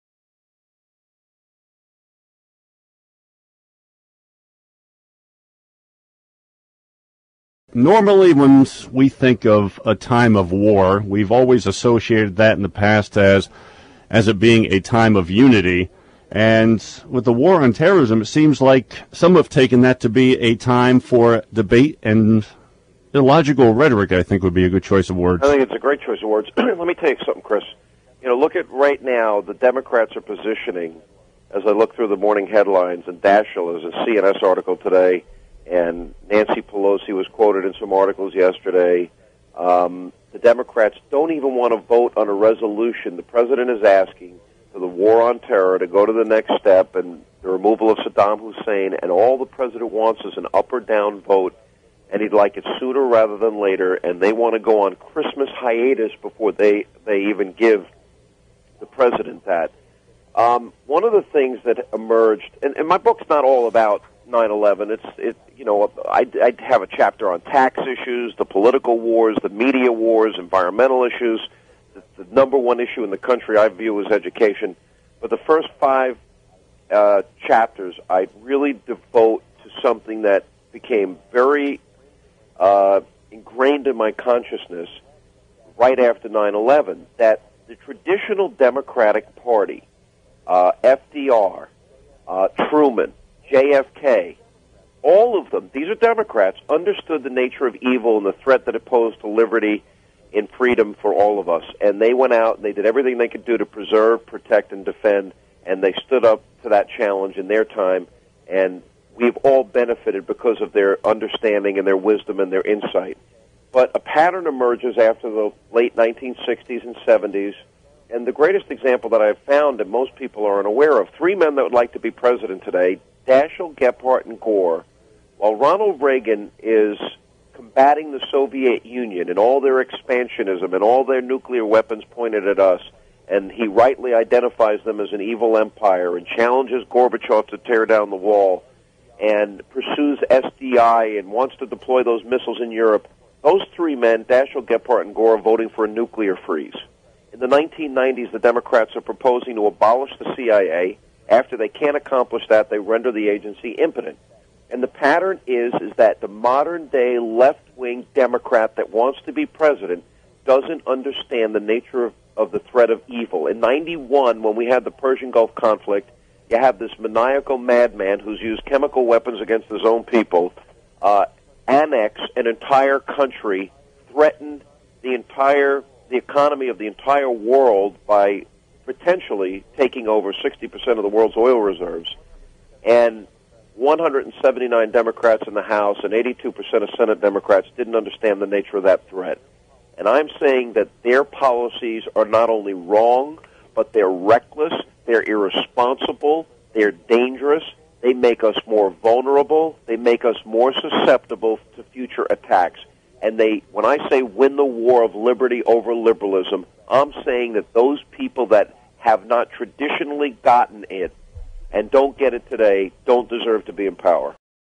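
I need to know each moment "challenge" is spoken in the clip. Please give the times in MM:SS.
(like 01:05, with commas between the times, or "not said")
01:46, 02:16.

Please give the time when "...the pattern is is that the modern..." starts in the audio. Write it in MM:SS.
02:34.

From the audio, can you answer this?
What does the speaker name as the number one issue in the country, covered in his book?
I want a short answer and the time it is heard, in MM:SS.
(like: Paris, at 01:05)
Education, at 01:14.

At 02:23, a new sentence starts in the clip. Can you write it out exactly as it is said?
Those three men, Daschle, Gephardt, and Gore, are voting for a nuclear freeze.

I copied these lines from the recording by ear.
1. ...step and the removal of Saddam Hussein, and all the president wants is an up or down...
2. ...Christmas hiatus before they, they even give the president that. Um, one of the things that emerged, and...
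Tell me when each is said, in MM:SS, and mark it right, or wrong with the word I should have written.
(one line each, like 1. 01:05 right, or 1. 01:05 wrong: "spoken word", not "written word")
1. 00:46 right
2. 00:54 right.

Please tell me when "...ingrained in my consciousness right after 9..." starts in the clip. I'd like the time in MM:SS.
01:23.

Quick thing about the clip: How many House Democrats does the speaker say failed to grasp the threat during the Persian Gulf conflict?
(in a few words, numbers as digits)
179.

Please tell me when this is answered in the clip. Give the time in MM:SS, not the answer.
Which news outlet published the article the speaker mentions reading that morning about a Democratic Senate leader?
00:34.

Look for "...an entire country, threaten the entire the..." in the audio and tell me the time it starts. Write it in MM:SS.
02:52.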